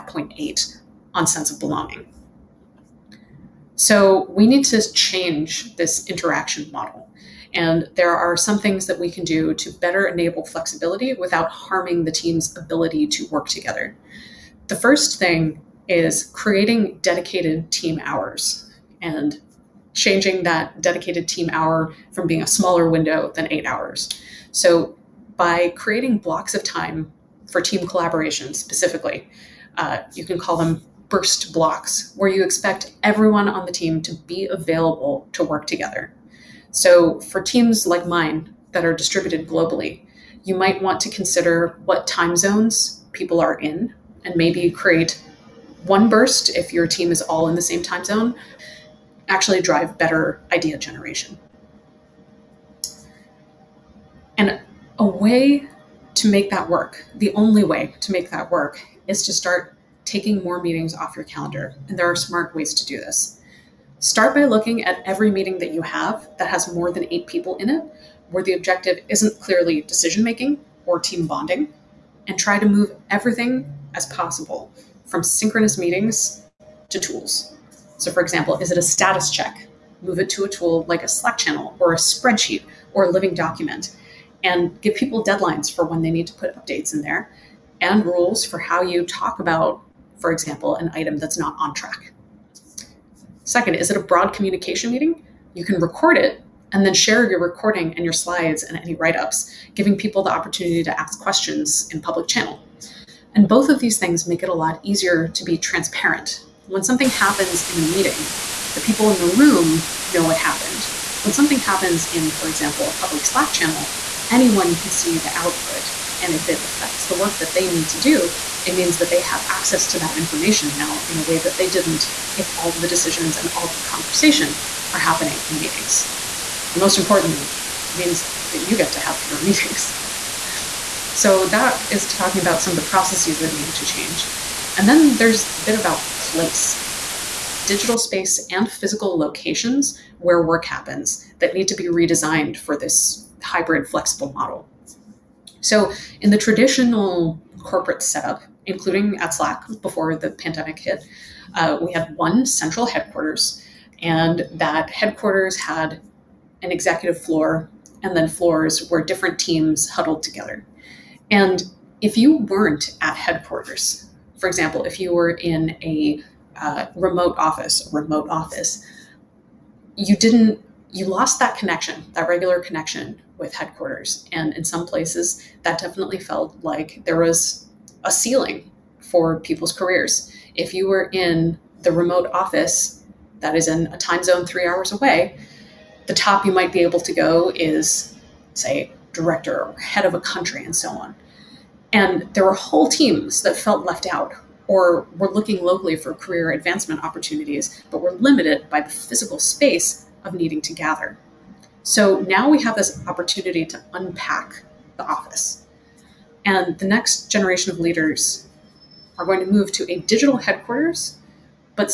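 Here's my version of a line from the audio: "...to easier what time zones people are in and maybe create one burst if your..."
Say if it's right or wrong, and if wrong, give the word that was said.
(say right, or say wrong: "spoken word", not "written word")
wrong: "consider", not "easier".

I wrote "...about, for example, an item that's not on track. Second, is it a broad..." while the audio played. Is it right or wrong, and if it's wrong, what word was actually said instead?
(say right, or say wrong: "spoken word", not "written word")
right.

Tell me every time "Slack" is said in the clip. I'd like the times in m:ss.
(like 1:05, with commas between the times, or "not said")
1:21, 1:53, 2:29.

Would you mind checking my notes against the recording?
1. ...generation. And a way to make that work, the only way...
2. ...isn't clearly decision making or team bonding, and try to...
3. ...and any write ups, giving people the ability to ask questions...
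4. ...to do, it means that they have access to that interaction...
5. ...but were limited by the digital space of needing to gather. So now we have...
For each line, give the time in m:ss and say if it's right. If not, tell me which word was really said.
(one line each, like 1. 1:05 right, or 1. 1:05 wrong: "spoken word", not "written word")
1. 0:50 right
2. 1:09 right
3. 1:38 wrong: "opportunity", not "ability"
4. 1:57 wrong: "information", not "interaction"
5. 3:17 wrong: "physical", not "digital".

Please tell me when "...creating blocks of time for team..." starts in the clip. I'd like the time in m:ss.
0:25.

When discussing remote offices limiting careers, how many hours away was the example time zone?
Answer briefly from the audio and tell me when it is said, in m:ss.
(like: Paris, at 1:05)
3, at 3:04.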